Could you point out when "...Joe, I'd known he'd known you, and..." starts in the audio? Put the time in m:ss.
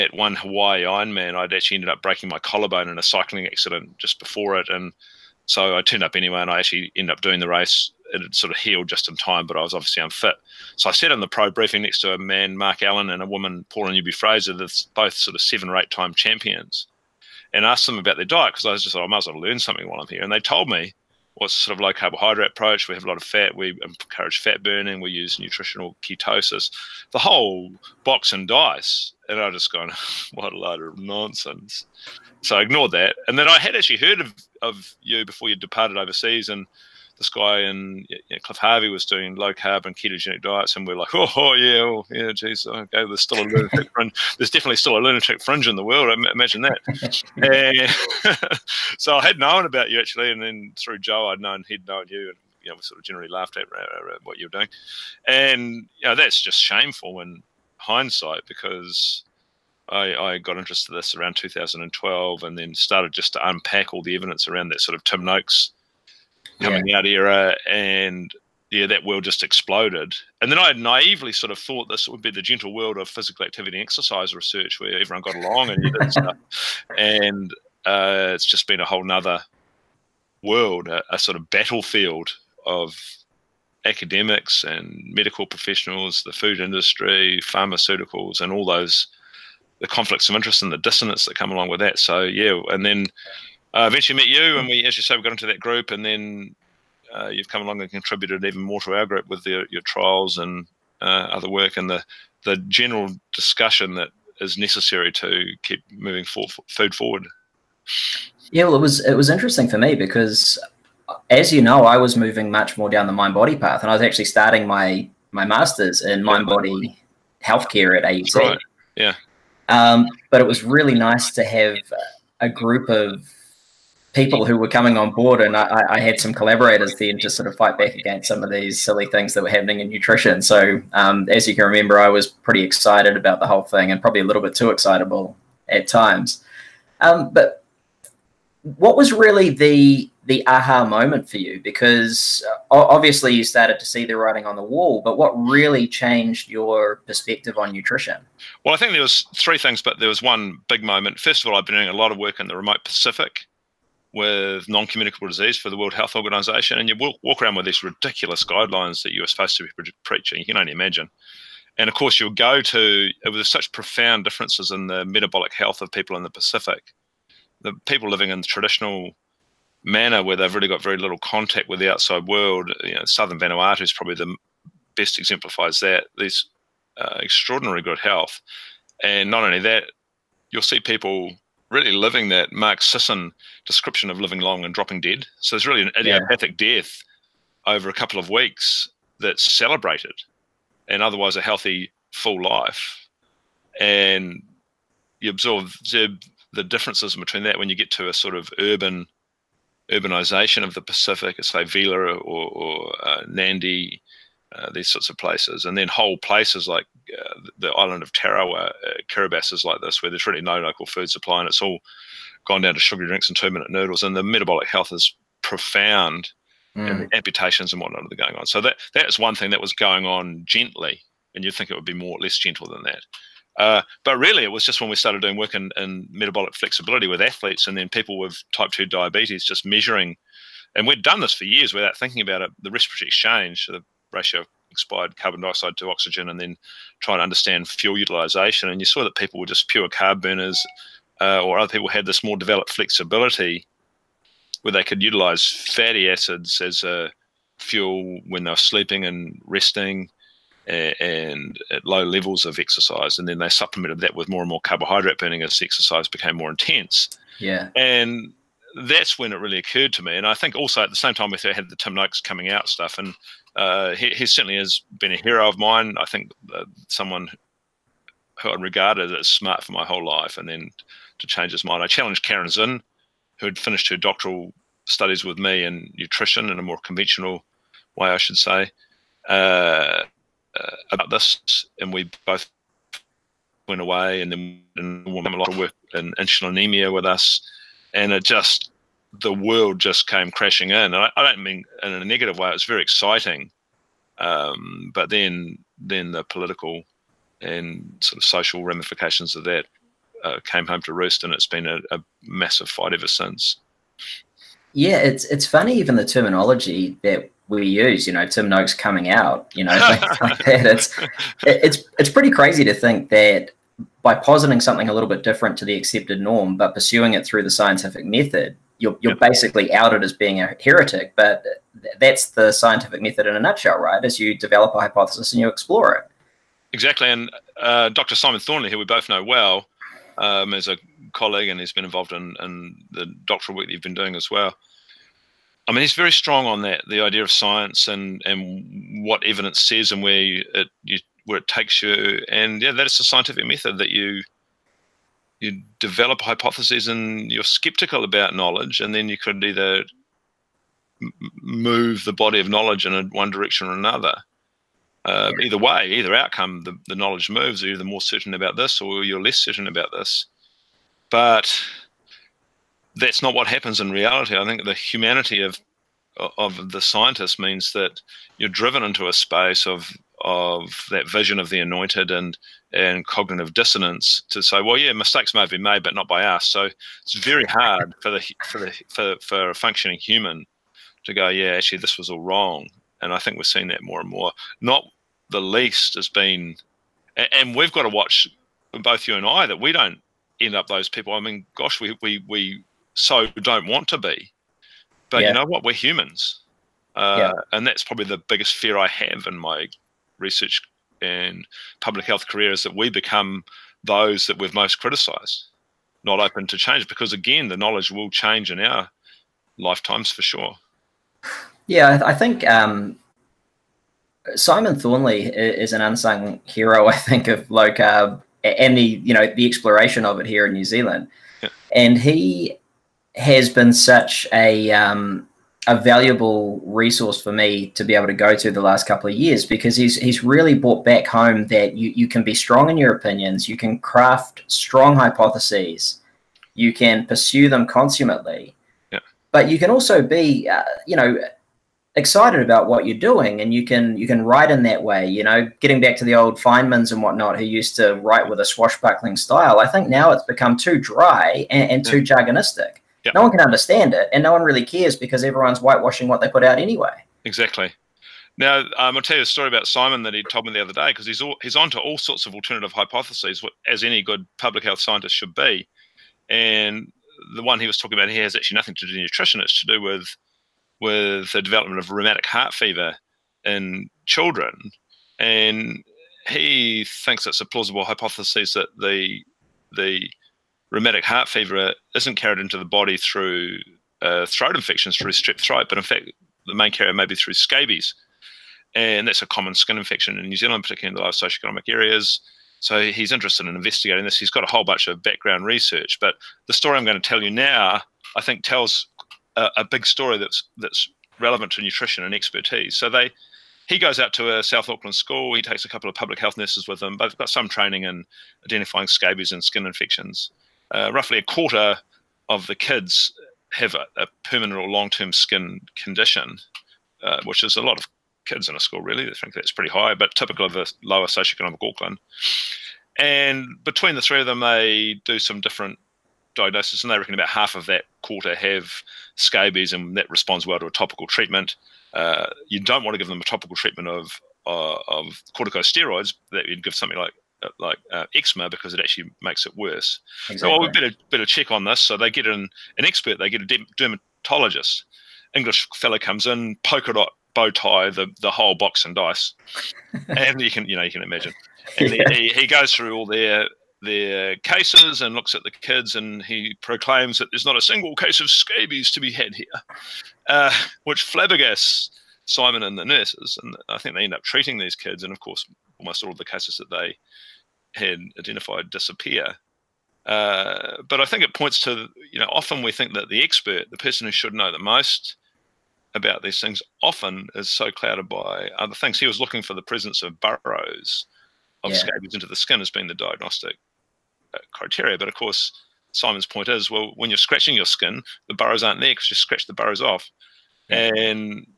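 0:50.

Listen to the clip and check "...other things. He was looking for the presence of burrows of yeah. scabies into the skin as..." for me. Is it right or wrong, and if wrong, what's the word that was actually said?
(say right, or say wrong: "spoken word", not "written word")
right.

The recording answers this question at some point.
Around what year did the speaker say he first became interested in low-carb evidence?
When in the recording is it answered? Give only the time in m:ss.
1:01.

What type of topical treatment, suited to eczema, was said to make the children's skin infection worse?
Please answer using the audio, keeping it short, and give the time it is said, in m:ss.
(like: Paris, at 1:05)
corticosteroids, at 8:55.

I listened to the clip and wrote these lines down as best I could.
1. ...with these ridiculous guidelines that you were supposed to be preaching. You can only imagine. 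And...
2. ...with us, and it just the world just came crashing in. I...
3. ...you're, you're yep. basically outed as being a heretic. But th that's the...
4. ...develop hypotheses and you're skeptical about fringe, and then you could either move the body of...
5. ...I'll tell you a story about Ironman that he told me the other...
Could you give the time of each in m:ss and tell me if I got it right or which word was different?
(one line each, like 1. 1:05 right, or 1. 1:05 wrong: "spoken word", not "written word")
1. 2:37 right
2. 4:46 right
3. 5:18 right
4. 5:45 wrong: "knowledge", not "fringe"
5. 7:38 wrong: "Simon", not "Ironman".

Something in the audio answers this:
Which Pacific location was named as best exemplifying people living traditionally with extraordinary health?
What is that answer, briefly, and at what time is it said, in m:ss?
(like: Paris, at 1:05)
southern Vanuatu, at 2:53.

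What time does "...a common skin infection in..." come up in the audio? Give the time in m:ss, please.
8:09.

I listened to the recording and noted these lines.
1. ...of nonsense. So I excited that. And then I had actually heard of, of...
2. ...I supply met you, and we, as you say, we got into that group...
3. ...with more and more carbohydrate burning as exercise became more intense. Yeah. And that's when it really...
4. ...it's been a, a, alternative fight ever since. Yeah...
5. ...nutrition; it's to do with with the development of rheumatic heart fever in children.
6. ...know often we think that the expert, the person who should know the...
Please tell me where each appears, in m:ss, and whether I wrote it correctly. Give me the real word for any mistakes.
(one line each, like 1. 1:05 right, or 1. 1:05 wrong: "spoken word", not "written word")
1. 0:30 wrong: "ignored", not "excited"
2. 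1:33 wrong: "eventually", not "supply"
3. 4:14 right
4. 5:01 wrong: "massive", not "alternative"
5. 7:49 right
6. 9:32 right.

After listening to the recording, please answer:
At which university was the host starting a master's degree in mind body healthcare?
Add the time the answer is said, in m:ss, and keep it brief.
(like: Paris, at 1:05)
AUT, at 1:58.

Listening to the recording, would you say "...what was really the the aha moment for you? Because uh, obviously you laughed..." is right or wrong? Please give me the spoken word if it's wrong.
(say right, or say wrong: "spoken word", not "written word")
wrong: "started", not "laughed".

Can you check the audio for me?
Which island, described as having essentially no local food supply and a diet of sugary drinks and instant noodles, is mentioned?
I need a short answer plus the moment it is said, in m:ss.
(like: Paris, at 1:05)
Tarawa, at 3:28.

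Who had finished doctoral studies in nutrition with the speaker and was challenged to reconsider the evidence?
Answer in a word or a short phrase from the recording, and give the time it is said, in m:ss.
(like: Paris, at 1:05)
Caryn Zinn, at 4:32.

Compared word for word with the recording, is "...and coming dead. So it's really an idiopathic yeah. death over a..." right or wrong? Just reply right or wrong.
wrong.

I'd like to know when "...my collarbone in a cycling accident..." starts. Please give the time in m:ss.
0:02.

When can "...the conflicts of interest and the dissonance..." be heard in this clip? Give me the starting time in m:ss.
1:29.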